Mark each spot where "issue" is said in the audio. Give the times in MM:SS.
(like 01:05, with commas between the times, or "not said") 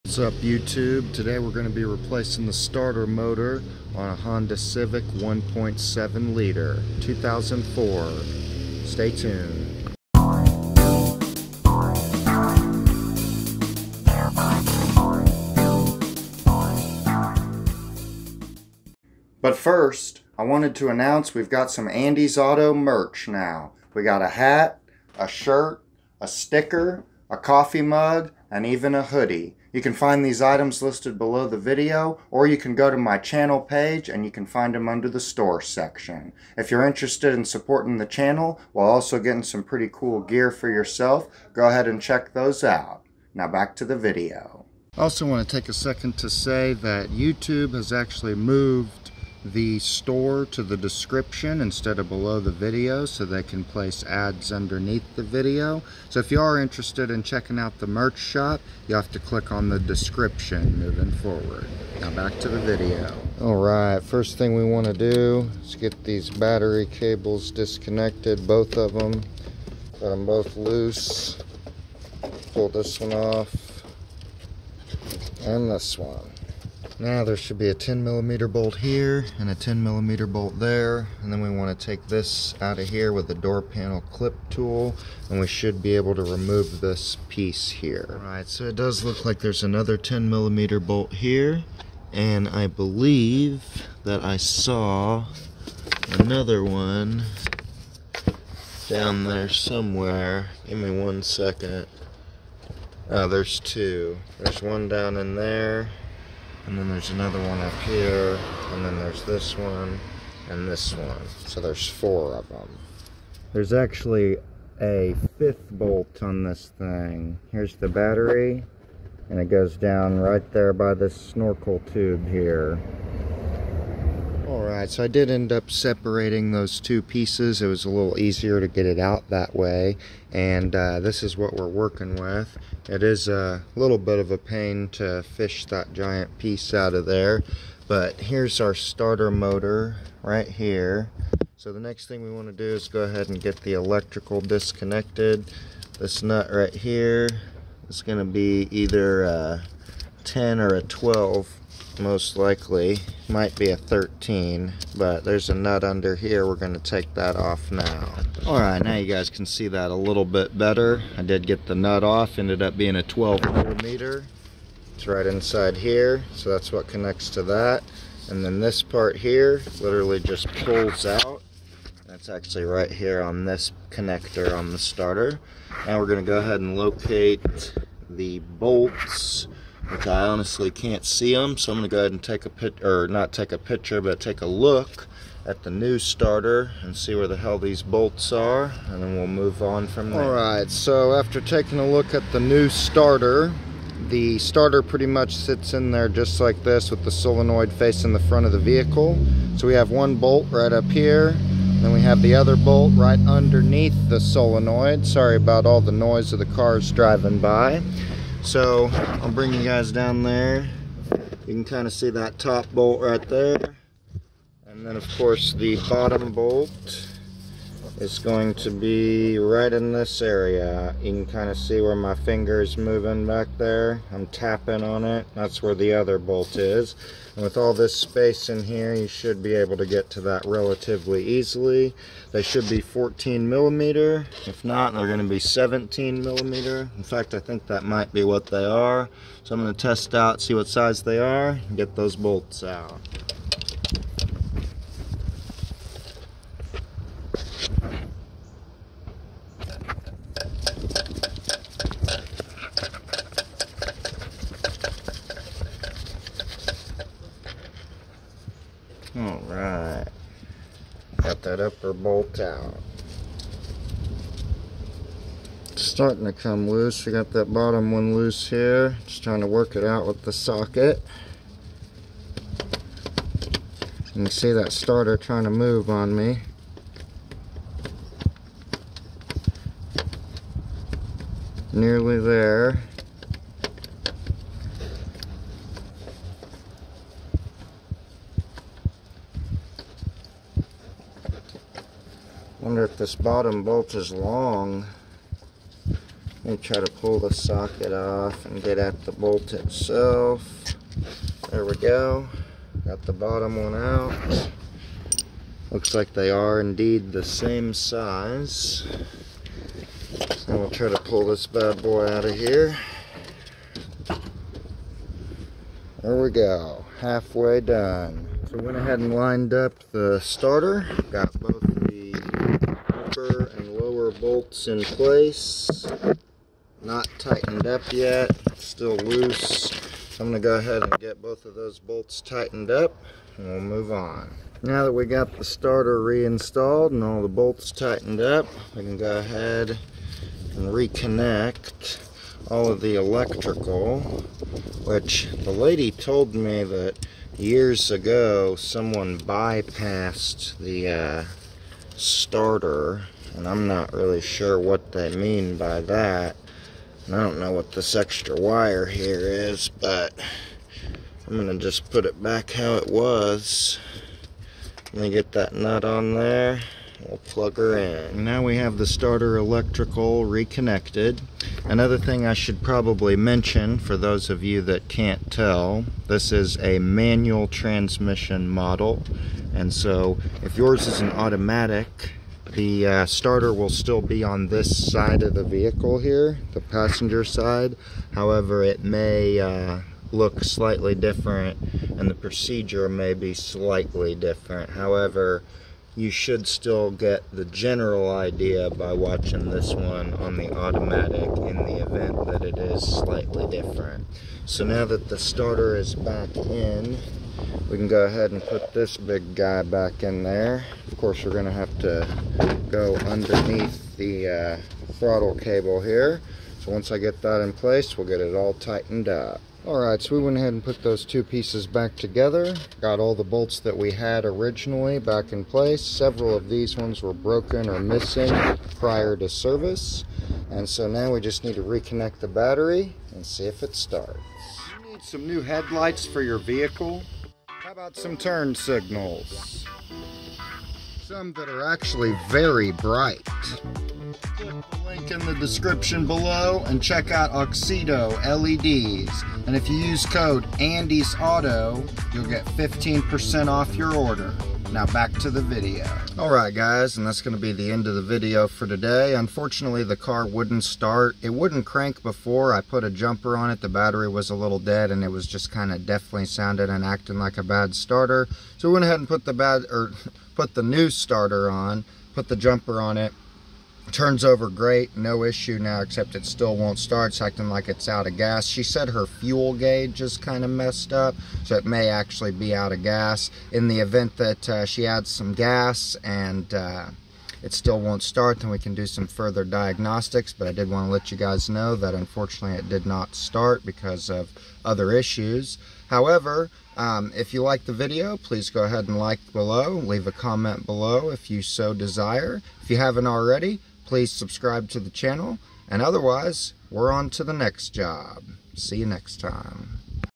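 07:55, 08:14.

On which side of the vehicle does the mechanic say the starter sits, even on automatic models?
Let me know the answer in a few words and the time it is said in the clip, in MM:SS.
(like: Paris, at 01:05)
passenger side, at 06:26.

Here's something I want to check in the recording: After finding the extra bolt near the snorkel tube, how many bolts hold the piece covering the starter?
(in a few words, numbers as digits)
5.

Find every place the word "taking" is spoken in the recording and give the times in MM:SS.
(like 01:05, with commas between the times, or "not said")
03:11.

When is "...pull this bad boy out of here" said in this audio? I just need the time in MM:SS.
05:10.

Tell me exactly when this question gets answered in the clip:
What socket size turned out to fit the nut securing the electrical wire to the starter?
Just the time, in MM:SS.
02:43.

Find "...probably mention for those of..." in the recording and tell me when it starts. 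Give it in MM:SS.
06:12.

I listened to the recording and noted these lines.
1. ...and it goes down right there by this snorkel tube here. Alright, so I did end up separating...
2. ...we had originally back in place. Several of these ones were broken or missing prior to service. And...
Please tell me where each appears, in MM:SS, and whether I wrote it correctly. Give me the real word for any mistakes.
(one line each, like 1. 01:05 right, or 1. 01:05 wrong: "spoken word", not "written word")
1. 01:59 right
2. 07:03 right.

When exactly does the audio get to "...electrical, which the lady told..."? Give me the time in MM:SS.
05:42.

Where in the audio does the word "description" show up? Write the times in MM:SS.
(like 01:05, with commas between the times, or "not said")
00:50, 00:59, 07:25.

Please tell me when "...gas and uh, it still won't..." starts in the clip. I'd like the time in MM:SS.
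08:05.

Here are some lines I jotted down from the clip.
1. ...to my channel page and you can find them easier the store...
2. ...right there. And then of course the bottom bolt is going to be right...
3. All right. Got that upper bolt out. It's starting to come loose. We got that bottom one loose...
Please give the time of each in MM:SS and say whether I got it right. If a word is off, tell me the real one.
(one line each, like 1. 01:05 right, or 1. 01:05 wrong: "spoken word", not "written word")
1. 00:32 wrong: "under", not "easier"
2. 03:33 right
3. 04:19 right.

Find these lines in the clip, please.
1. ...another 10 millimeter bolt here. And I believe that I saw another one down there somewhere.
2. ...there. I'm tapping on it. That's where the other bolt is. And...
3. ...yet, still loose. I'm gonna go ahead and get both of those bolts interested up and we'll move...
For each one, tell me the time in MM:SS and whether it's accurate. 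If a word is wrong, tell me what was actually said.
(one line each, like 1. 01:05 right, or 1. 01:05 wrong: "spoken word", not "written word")
1. 01:29 right
2. 03:43 right
3. 05:27 wrong: "tightened", not "interested".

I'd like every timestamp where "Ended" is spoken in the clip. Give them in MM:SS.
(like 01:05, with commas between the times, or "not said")
02:42.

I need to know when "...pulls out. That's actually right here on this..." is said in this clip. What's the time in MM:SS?
02:50.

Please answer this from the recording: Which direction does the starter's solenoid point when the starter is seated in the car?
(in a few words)
front of the vehicle.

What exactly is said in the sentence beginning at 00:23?
We got a hat, a shirt, a sticker, a coffee mug, and even a hoodie.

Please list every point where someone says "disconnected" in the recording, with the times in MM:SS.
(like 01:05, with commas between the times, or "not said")
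01:07, 02:24.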